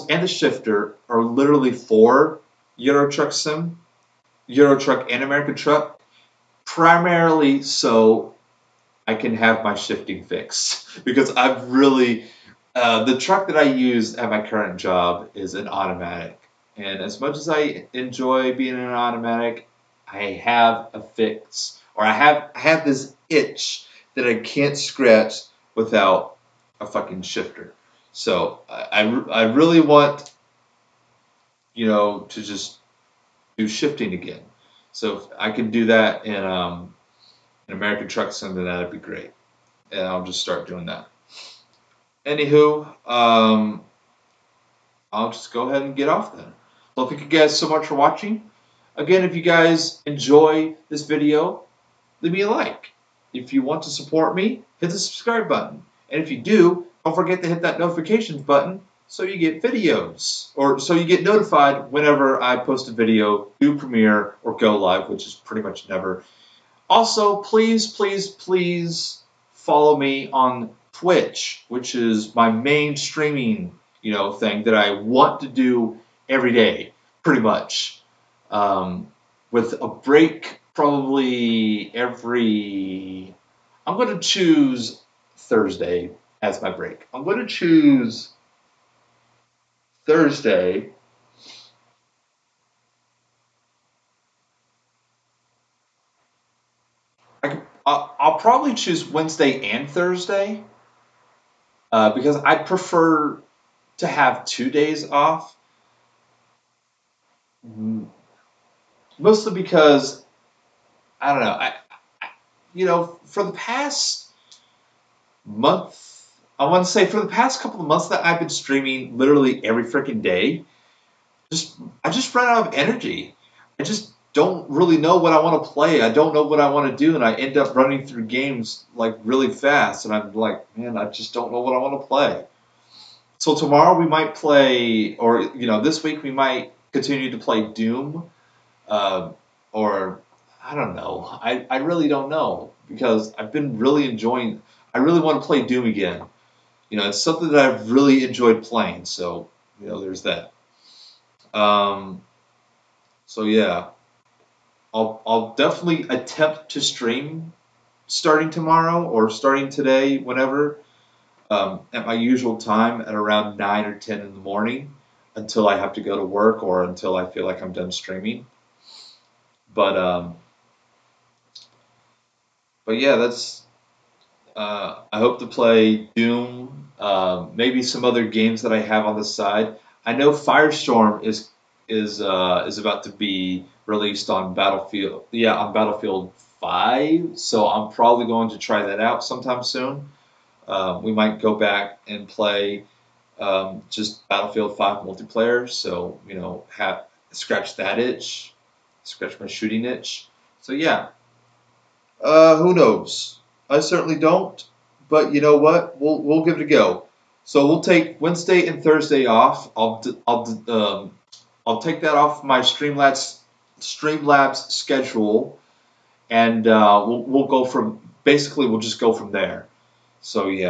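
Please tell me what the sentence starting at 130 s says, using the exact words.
And I'm like, man, I just don't know what I want to play.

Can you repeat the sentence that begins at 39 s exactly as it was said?
And I'll just start doing that.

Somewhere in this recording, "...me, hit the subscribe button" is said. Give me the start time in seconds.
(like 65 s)
54 s.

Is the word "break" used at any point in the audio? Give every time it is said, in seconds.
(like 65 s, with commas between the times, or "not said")
79 s, 86 s.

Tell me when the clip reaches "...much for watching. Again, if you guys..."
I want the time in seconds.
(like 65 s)
47 s.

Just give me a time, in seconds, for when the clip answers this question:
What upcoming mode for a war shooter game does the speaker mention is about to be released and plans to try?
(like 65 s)
180 s.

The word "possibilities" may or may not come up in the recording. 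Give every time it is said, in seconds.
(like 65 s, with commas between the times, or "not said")
not said.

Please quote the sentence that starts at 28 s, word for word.
So I, I, I really want you know to just do shifting again.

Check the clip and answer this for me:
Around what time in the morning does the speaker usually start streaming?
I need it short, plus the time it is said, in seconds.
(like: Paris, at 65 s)
9 or 10, at 163 s.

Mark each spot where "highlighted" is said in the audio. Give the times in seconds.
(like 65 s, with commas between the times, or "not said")
not said.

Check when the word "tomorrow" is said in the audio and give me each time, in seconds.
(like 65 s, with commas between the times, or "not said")
133 s, 158 s.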